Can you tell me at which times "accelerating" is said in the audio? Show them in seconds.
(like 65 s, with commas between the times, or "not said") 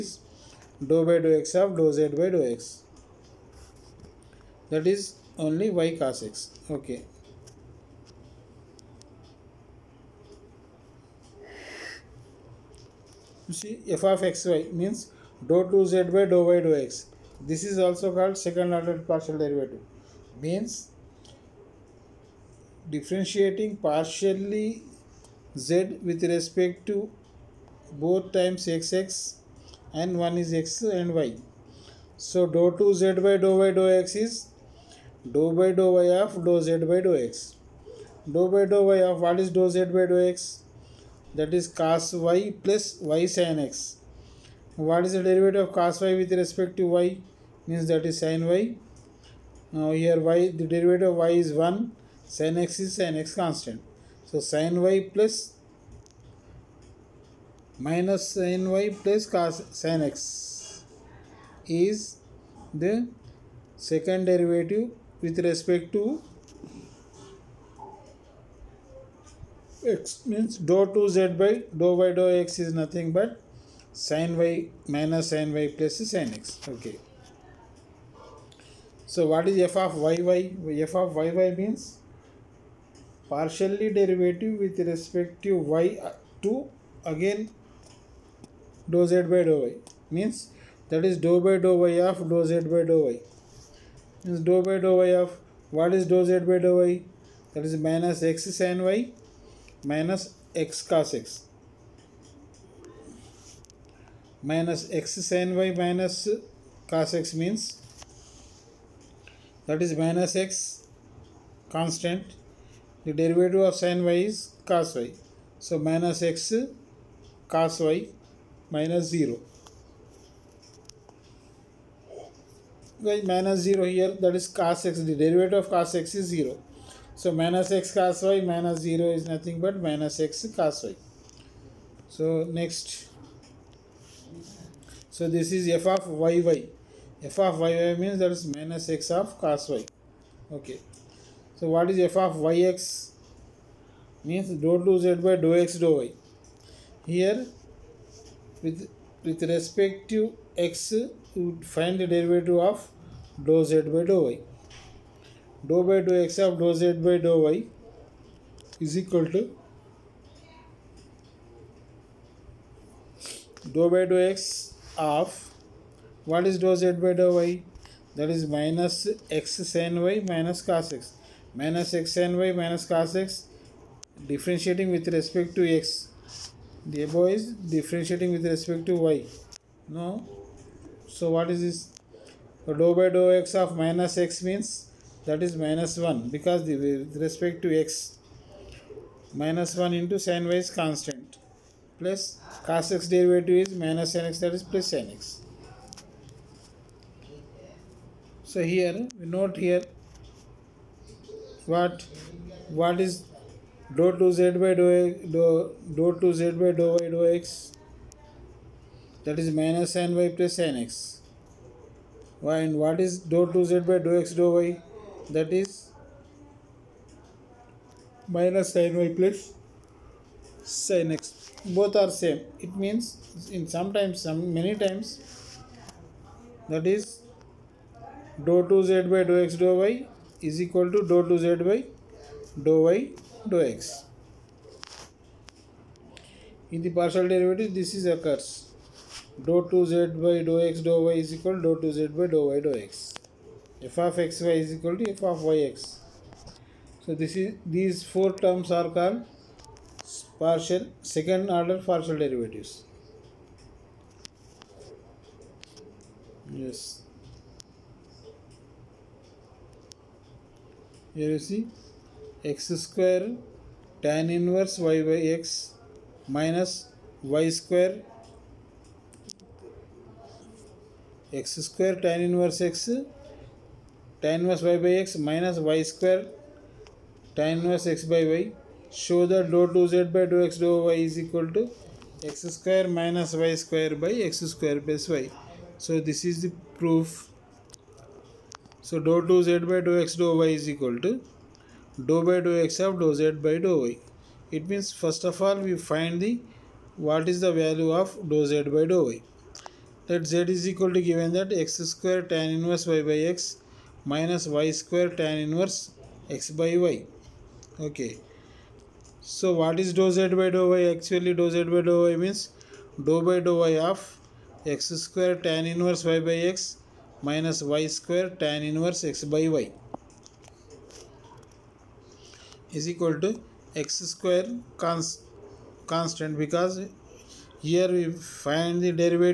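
not said.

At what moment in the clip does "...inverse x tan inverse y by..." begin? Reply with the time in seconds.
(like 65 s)
272 s.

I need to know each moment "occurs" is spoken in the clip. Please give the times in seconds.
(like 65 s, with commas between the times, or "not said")
238 s.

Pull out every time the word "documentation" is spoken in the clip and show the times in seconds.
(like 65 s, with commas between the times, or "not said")
not said.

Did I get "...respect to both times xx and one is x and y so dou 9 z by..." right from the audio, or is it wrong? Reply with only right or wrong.
wrong.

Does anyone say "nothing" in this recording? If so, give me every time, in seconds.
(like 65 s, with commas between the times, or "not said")
72 s, 129 s.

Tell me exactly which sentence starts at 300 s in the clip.
That z is equal to given that x square tan inverse y by x minus y square tan inverse x by y.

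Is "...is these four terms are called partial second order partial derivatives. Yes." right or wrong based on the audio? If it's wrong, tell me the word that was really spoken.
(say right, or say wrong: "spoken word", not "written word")
right.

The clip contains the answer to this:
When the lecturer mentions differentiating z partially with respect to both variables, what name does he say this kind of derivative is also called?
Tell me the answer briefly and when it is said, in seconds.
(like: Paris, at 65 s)
second order partial derivative, at 18 s.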